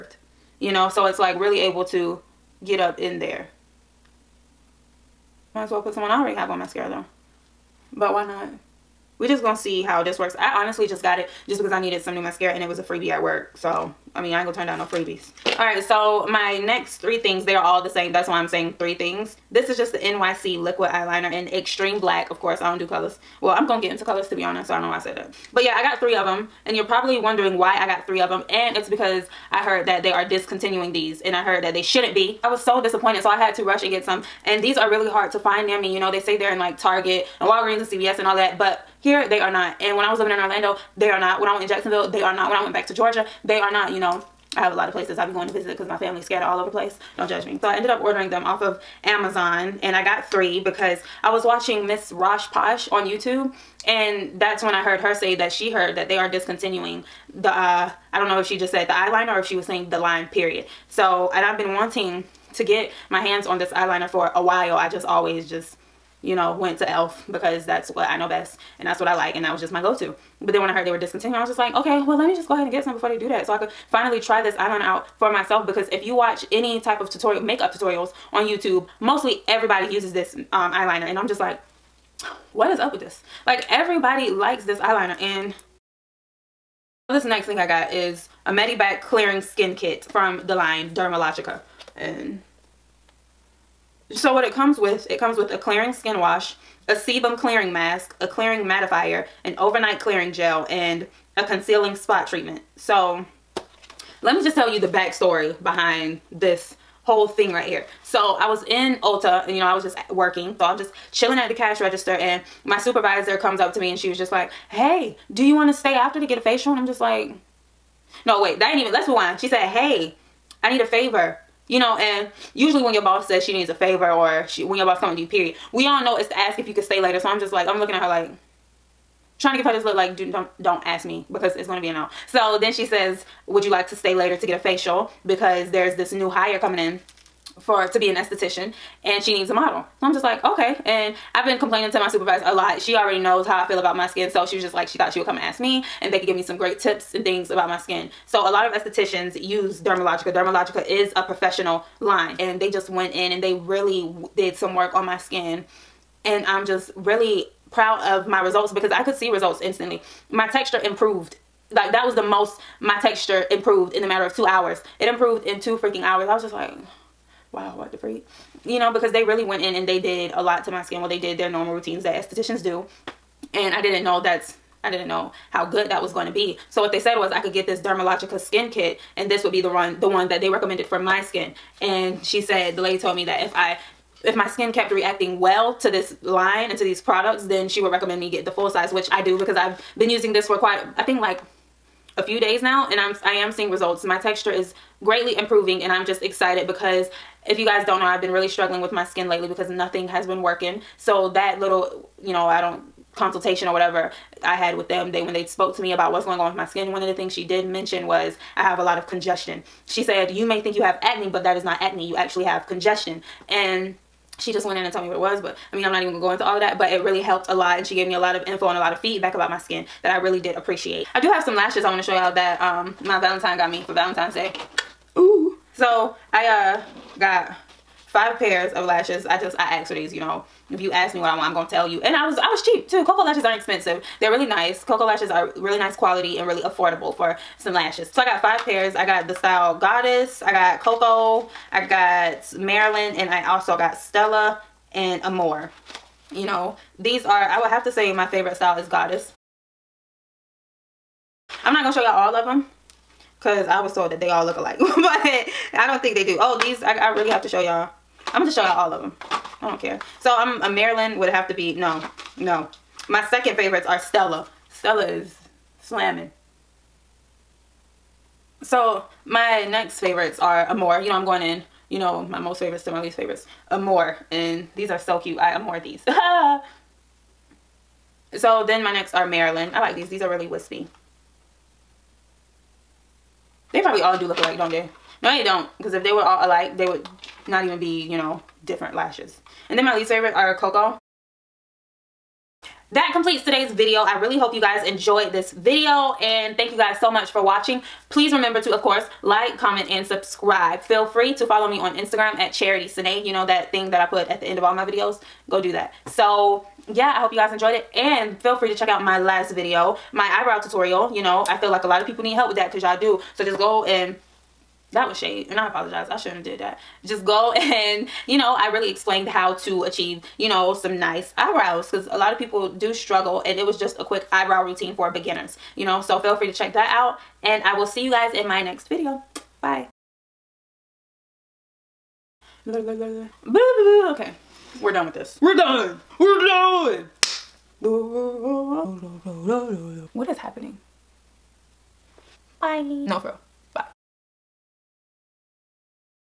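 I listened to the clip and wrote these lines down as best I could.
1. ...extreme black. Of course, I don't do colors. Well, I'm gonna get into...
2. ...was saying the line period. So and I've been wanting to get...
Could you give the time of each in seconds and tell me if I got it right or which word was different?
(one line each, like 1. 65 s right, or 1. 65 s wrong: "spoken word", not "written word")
1. 21 s right
2. 59 s right.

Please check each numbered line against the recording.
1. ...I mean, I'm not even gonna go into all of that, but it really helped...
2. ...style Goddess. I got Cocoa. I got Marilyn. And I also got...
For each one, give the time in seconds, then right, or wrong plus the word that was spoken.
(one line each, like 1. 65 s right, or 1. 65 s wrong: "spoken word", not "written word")
1. 215 s right
2. 239 s right.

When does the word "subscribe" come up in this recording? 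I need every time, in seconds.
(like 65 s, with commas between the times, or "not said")
300 s.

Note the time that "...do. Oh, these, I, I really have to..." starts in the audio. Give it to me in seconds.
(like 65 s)
256 s.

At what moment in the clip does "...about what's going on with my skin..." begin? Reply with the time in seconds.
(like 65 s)
205 s.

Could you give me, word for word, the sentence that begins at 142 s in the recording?
She already knows how I feel about my skin.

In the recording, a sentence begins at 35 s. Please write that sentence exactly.
You know, they say they're in like Target and Walgreens and CVS and all that but here they are not.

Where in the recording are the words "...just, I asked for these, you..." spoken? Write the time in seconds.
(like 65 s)
229 s.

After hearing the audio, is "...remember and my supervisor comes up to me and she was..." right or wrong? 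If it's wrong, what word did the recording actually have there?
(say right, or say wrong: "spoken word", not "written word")
wrong: "register", not "remember".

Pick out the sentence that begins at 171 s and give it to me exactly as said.
Well, they did their normal routines that estheticians do.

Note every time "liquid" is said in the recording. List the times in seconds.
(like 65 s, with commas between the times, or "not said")
20 s.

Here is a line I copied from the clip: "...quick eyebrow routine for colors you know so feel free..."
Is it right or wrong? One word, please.
wrong.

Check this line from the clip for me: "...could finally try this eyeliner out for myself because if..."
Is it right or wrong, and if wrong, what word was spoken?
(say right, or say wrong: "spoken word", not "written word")
right.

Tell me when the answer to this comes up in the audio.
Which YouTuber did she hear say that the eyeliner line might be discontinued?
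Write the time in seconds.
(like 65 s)
51 s.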